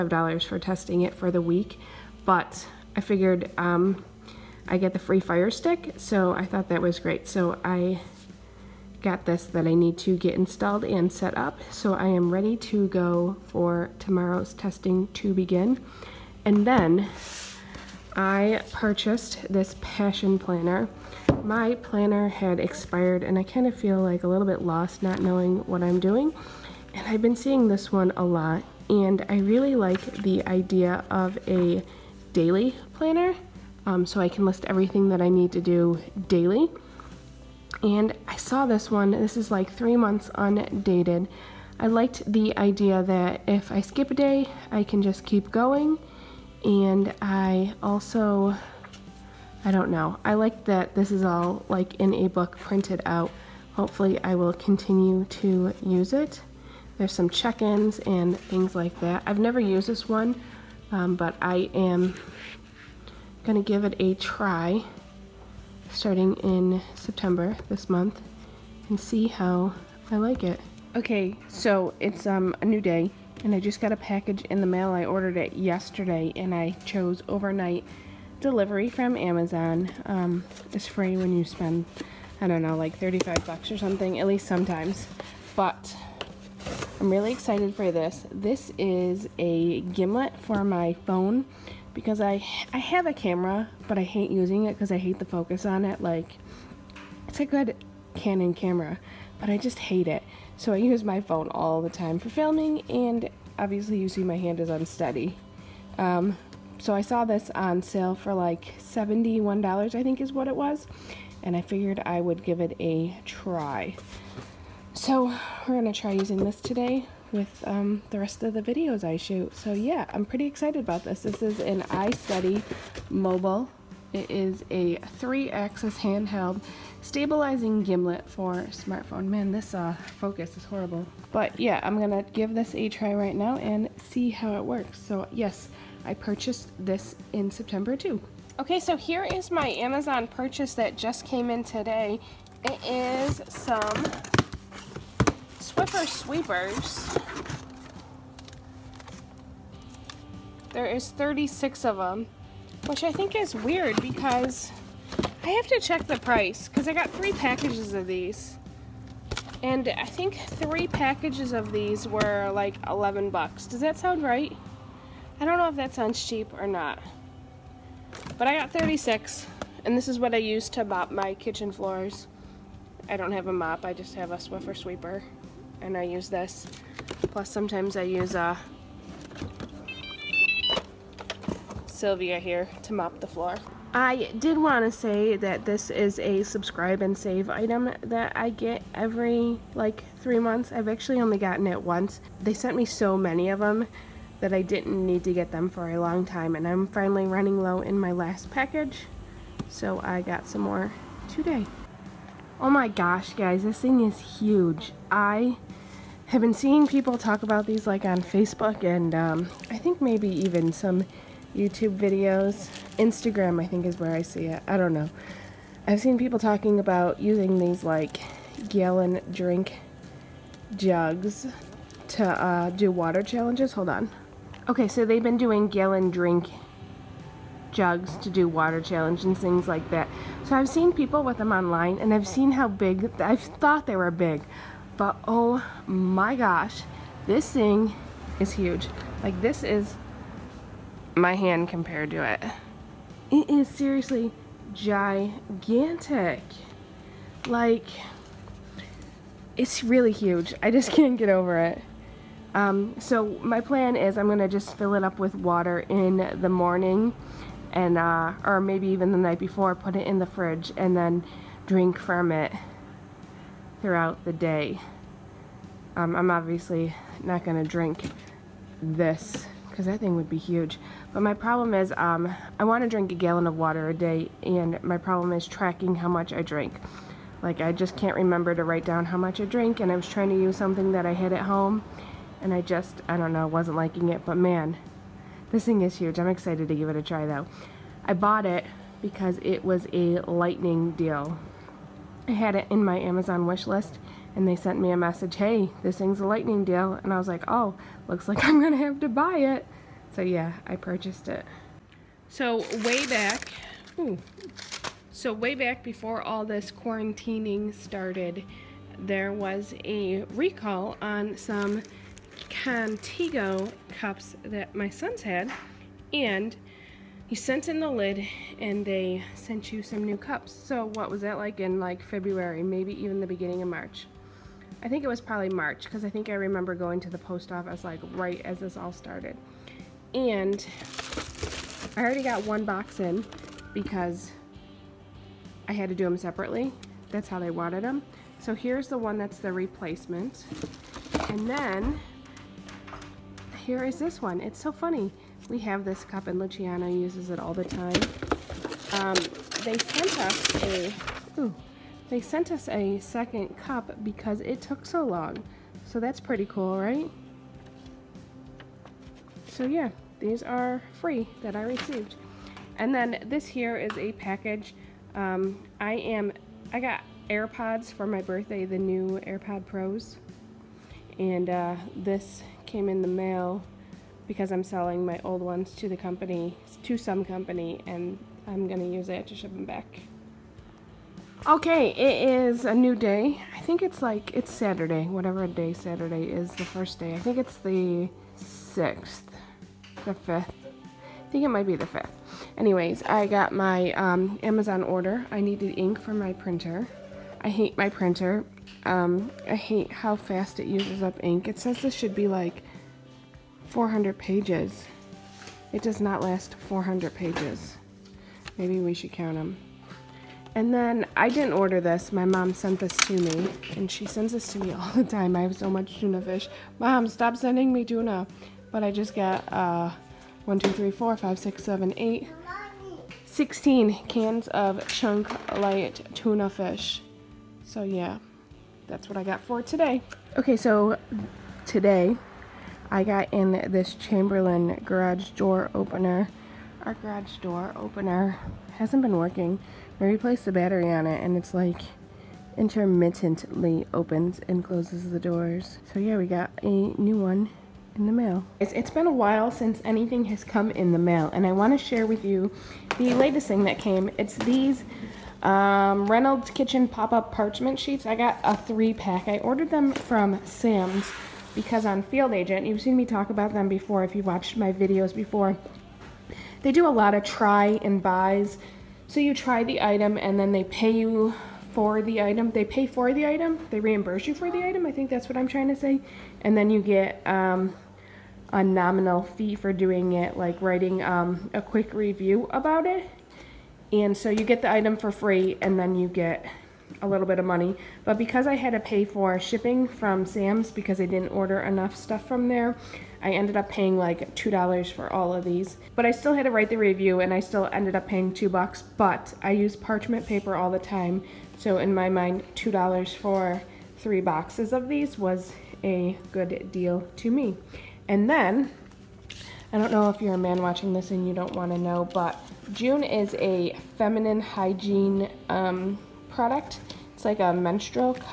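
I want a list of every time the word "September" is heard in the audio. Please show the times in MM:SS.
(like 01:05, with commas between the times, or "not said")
01:06, 02:17.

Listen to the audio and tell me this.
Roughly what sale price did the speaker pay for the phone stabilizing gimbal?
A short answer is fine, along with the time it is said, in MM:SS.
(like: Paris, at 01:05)
$71, at 01:48.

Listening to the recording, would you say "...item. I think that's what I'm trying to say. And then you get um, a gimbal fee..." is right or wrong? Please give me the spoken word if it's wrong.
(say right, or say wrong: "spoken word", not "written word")
wrong: "nominal", not "gimbal".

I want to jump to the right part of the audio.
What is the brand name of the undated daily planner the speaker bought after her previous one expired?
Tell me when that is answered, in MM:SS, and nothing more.
00:19.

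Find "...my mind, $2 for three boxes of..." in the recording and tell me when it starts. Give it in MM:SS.
08:21.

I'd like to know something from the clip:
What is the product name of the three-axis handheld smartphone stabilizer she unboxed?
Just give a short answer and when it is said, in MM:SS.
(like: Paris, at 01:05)
iSteady mobile, at 02:01.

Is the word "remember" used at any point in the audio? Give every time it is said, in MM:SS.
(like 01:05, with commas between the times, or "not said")
04:38, 05:26.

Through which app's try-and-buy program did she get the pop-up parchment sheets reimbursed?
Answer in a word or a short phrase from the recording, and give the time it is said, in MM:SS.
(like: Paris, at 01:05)
Field Agent, at 07:42.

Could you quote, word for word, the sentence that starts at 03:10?
I've actually only gotten it once.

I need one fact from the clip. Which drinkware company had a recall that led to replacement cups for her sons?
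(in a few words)
Contigo.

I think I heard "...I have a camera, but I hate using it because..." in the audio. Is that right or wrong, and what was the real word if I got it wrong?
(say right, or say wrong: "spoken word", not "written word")
right.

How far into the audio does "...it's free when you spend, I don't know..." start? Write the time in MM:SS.
01:20.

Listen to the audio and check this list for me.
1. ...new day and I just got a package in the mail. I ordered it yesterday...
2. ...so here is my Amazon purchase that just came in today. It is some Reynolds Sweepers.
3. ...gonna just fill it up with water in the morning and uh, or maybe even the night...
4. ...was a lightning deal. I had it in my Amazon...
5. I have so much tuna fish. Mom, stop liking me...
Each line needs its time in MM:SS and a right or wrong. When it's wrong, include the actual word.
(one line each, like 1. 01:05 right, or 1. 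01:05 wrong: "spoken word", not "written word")
1. 01:12 right
2. 02:18 wrong: "Swiffer", not "Reynolds"
3. 04:14 right
4. 04:49 right
5. 06:55 wrong: "sending", not "liking".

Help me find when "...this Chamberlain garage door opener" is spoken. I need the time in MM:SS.
07:13.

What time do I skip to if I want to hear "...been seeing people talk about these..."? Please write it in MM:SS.
03:26.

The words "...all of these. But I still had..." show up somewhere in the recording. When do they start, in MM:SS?
08:15.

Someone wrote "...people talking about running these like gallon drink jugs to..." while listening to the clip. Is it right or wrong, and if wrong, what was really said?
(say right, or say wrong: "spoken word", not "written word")
wrong: "using", not "running".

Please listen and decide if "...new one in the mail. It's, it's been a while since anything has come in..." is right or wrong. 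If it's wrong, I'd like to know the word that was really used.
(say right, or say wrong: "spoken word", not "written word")
right.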